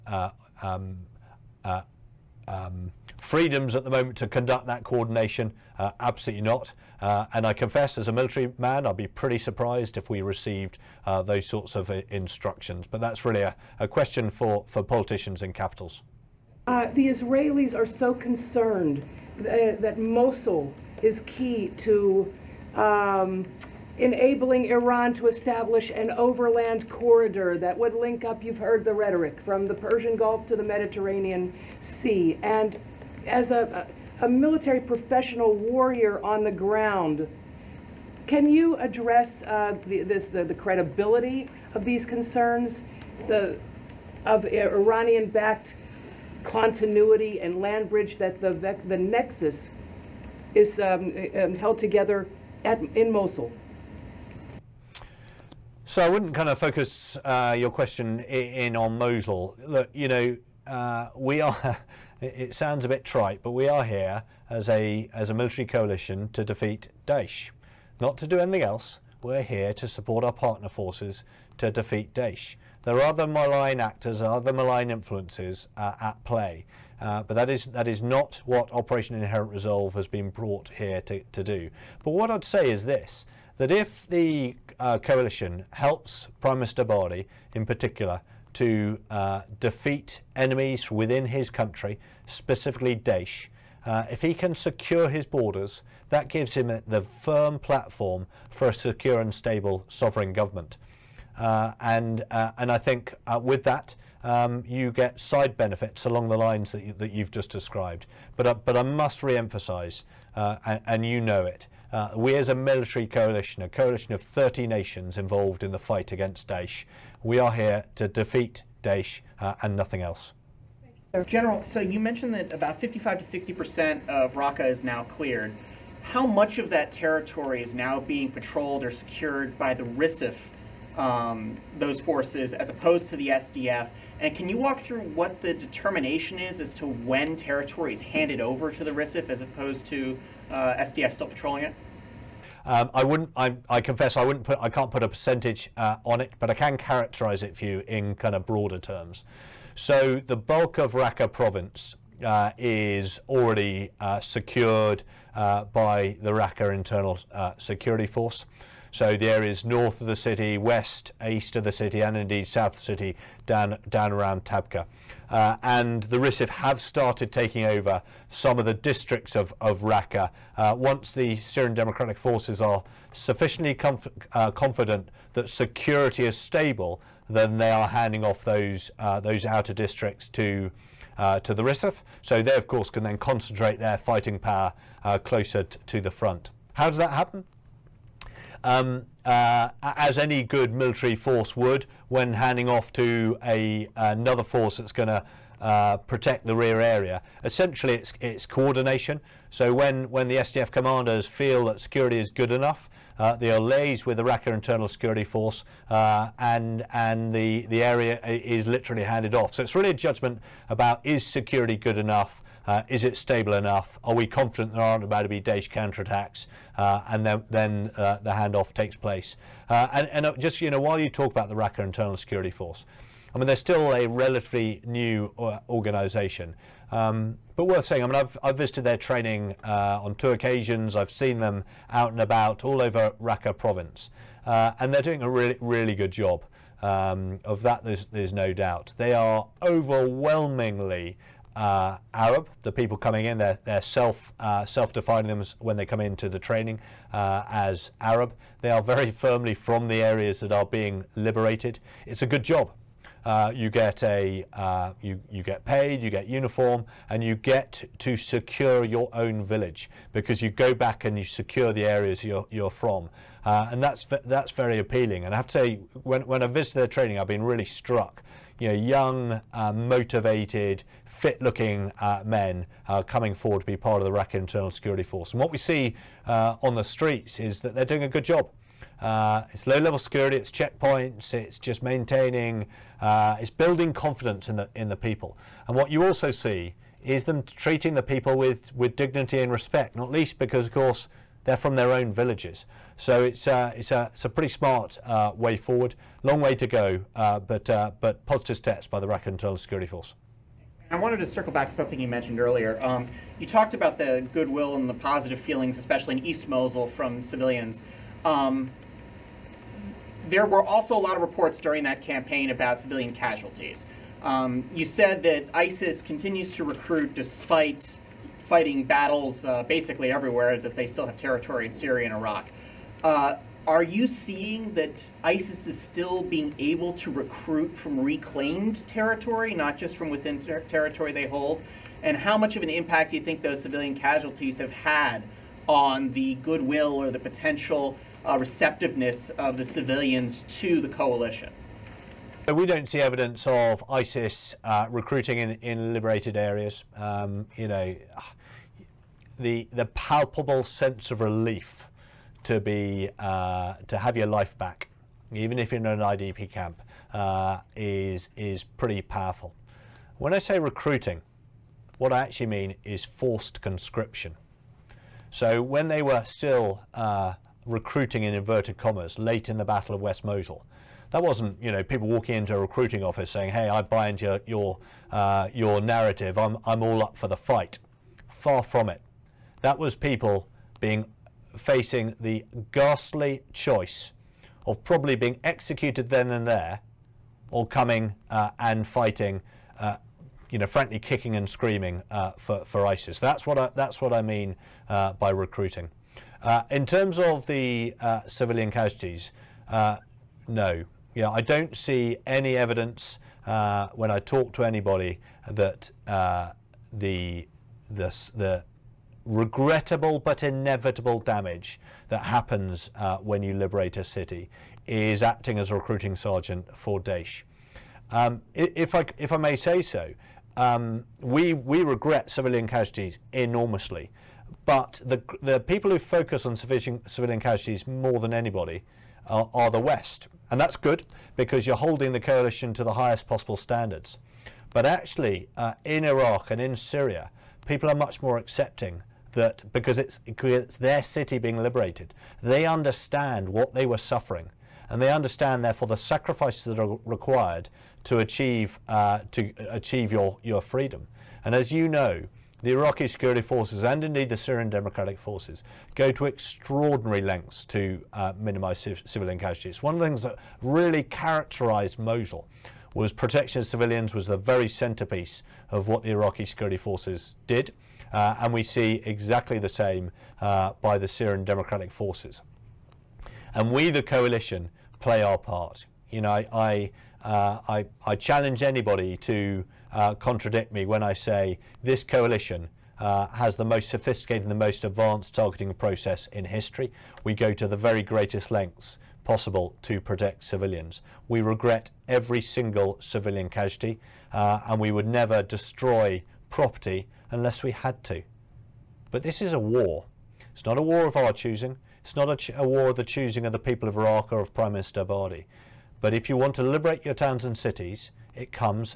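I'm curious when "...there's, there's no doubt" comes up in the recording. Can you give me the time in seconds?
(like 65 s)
237 s.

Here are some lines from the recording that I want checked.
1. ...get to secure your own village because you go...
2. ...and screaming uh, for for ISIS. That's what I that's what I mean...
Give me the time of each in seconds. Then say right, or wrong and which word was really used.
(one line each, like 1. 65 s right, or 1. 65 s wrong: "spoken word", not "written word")
1. 257 s right
2. 391 s right.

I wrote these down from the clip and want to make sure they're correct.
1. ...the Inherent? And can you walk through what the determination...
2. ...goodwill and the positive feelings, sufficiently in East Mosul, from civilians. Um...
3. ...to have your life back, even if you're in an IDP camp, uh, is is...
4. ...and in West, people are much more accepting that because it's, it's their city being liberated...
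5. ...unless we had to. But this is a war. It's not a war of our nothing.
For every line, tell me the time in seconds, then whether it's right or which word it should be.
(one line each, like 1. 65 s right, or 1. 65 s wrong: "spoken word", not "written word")
1. 133 s wrong: "SDF", not "Inherent"
2. 304 s wrong: "especially", not "sufficiently"
3. 353 s right
4. 436 s wrong: "Syria", not "West"
5. 497 s wrong: "choosing", not "nothing".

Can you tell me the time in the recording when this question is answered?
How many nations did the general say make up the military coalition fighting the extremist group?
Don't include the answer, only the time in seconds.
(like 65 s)
114 s.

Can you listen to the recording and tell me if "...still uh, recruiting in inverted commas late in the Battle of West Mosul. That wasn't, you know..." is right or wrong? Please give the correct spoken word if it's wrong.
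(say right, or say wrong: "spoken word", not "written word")
right.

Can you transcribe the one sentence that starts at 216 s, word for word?
Uh, and then, then uh, the handoff takes place.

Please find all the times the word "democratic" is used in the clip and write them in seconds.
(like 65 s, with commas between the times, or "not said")
171 s, 454 s, 471 s.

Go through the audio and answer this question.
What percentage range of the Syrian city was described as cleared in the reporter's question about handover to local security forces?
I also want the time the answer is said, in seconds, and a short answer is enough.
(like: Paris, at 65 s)
55 to 60 percent, at 122 s.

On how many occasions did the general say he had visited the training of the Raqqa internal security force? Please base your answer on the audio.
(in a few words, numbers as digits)
2.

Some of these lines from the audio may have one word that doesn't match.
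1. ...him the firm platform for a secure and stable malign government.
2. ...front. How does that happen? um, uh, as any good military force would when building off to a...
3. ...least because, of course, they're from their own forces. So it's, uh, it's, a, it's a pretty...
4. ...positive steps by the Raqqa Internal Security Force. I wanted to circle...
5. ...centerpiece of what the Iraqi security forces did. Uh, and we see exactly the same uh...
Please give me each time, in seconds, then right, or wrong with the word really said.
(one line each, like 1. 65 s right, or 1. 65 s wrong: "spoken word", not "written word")
1. 96 s wrong: "sovereign", not "malign"
2. 186 s wrong: "handing", not "building"
3. 290 s wrong: "villages", not "forces"
4. 298 s right
5. 464 s right.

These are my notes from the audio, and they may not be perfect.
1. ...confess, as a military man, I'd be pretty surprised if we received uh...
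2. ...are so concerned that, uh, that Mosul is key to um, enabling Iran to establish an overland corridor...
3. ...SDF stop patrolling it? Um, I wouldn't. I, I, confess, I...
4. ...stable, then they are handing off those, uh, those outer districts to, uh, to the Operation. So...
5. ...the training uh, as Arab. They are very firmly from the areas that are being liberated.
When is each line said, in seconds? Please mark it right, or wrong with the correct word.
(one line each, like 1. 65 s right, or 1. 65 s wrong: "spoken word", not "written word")
1. 7 s right
2. 17 s right
3. 140 s right
4. 176 s wrong: "RISIF", not "Operation"
5. 246 s right.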